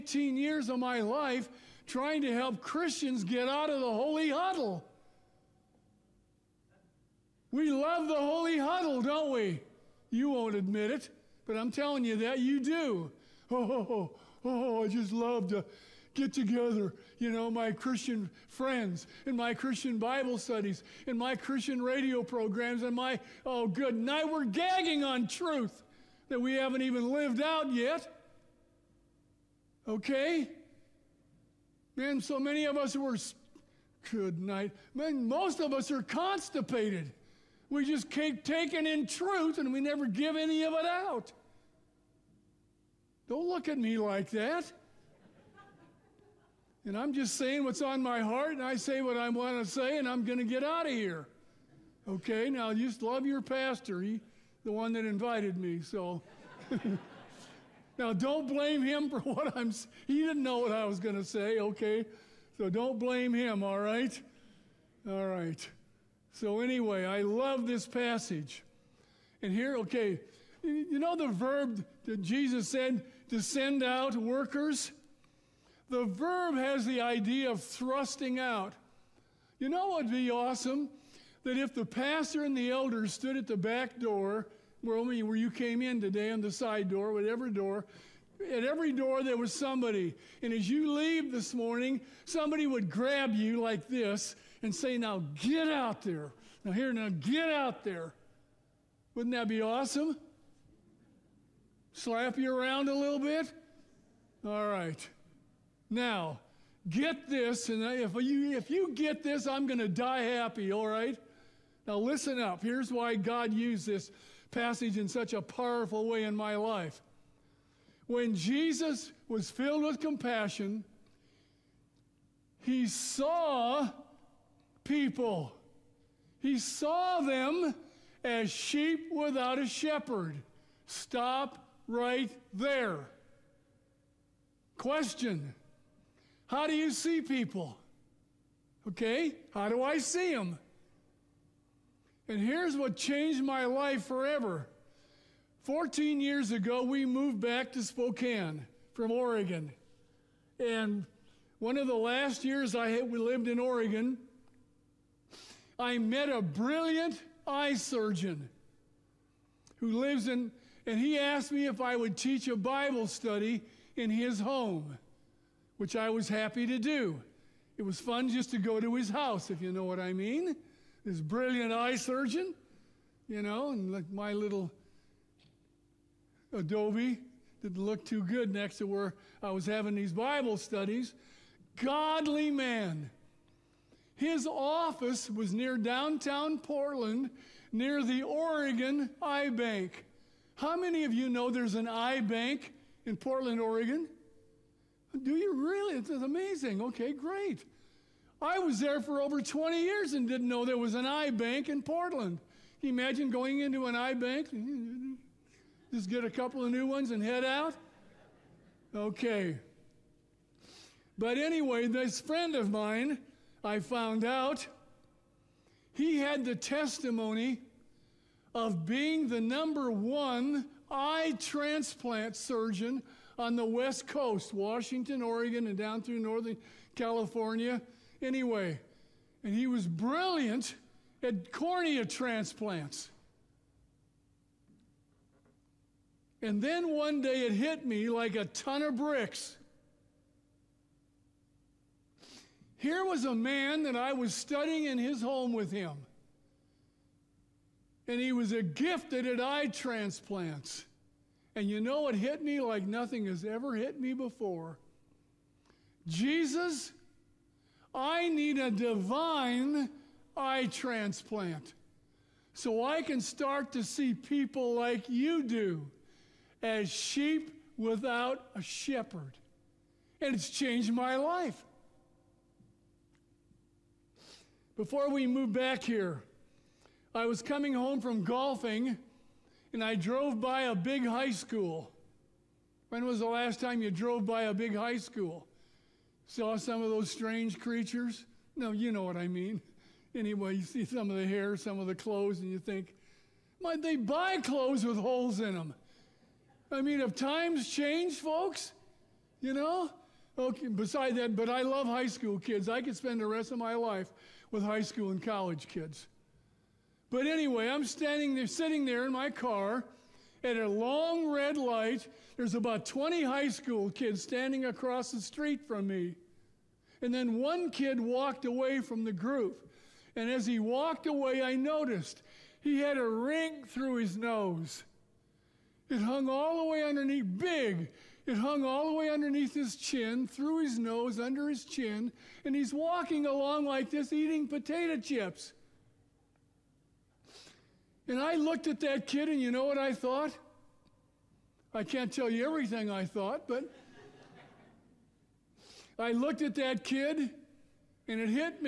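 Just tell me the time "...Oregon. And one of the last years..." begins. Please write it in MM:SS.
02:29.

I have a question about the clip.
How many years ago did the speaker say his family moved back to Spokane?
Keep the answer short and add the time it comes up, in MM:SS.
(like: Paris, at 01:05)
14, at 02:25.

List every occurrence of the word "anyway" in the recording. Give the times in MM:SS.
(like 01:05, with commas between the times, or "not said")
01:06, 03:31, 03:48, 04:50, 05:07.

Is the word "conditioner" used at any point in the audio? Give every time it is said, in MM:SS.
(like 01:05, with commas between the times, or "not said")
not said.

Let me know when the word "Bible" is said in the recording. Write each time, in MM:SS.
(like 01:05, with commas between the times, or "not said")
00:19, 02:42, 03:00.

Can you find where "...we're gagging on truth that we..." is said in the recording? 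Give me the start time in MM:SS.
00:24.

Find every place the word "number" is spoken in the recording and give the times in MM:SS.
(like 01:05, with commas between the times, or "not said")
03:39.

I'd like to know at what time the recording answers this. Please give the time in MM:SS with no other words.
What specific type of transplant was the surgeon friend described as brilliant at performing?
03:51.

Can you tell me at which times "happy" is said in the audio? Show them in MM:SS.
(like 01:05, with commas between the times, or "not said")
01:50, 02:46.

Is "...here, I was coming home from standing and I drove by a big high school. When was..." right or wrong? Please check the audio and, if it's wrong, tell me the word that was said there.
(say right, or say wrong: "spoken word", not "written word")
wrong: "golfing", not "standing".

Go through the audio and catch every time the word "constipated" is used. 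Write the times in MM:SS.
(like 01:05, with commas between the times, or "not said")
00:36.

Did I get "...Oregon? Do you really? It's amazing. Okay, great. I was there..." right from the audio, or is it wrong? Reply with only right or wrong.
right.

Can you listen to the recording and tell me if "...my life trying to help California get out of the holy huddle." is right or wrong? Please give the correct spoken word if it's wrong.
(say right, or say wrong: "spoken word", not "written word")
wrong: "Christians", not "California".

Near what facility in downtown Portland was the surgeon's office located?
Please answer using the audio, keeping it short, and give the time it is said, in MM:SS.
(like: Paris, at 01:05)
Oregon Eye Bank, at 03:08.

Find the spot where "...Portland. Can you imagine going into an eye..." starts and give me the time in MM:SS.
03:21.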